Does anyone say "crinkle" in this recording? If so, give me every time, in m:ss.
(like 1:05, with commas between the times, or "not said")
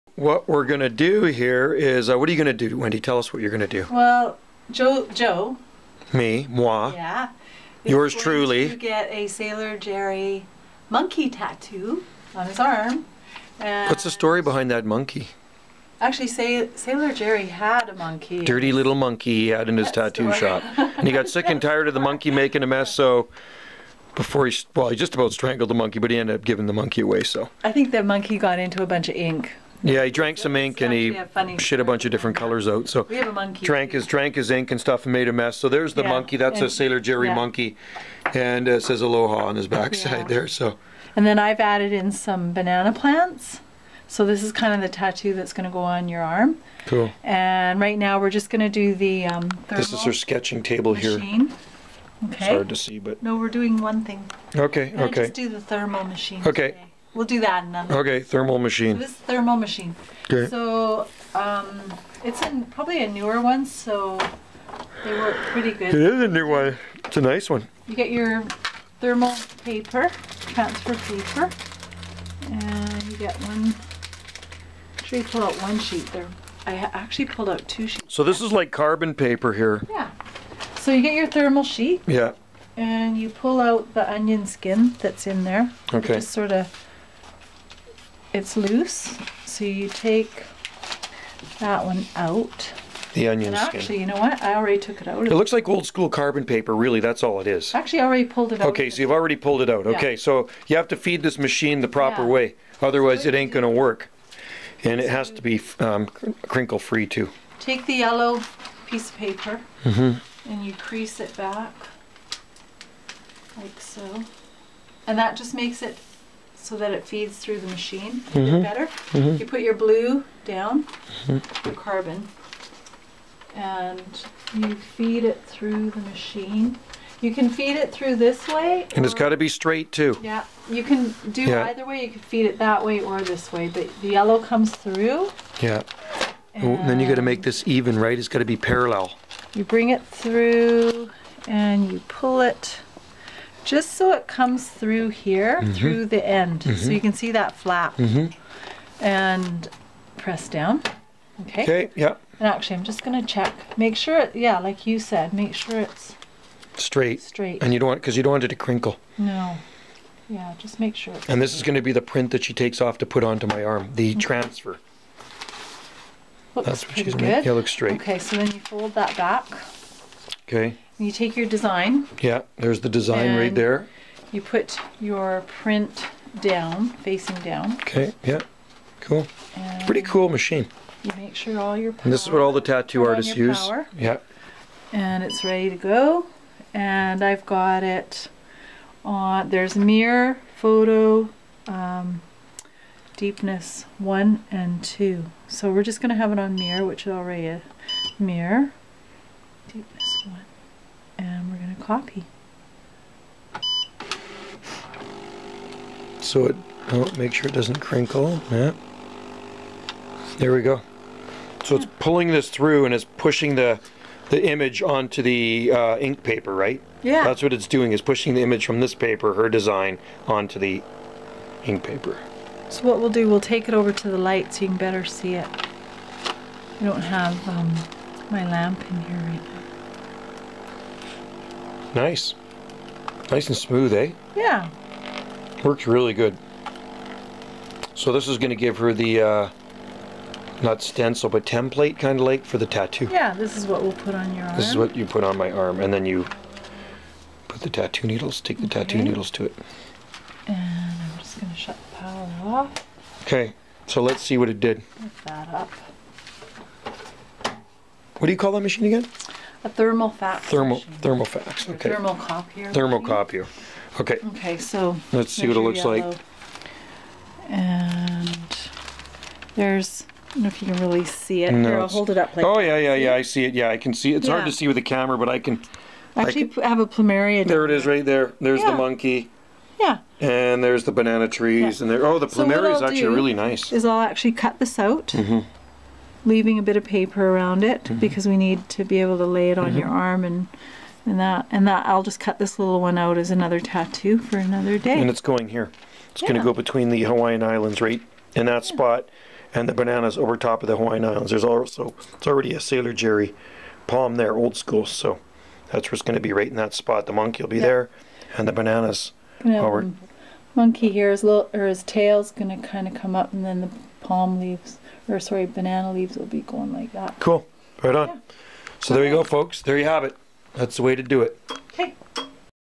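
1:46, 2:38, 3:27.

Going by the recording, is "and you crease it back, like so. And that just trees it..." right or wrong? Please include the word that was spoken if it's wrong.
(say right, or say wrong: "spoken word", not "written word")
wrong: "makes", not "trees".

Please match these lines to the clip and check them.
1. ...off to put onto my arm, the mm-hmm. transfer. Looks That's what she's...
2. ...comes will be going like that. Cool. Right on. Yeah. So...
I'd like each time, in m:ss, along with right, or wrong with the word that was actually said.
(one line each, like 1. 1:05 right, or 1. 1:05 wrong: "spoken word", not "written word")
1. 2:42 right
2. 5:15 wrong: "leaves", not "comes".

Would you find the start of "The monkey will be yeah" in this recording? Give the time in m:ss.
5:07.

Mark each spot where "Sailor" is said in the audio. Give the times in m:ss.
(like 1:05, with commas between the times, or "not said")
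0:09, 0:16, 0:36, 5:02.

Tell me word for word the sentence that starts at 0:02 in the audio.
Tell us what you're going to do.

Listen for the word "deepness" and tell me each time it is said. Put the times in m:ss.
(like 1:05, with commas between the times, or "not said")
3:13, 3:19.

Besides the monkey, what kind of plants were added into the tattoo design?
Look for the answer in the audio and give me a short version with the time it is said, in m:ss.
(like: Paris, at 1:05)
Banana plants, at 0:42.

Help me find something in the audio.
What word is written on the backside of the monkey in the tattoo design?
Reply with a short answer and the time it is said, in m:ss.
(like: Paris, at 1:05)
Aloha, at 0:39.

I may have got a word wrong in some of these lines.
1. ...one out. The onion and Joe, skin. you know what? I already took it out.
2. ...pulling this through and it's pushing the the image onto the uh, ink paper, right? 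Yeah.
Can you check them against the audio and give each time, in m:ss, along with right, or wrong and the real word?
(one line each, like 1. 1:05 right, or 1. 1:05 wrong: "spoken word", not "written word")
1. 1:31 wrong: "Actually", not "Joe"
2. 3:31 right.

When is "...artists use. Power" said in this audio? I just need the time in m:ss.
3:03.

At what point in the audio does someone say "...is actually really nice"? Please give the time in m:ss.
4:42.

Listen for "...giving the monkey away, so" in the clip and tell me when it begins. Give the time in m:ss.
0:26.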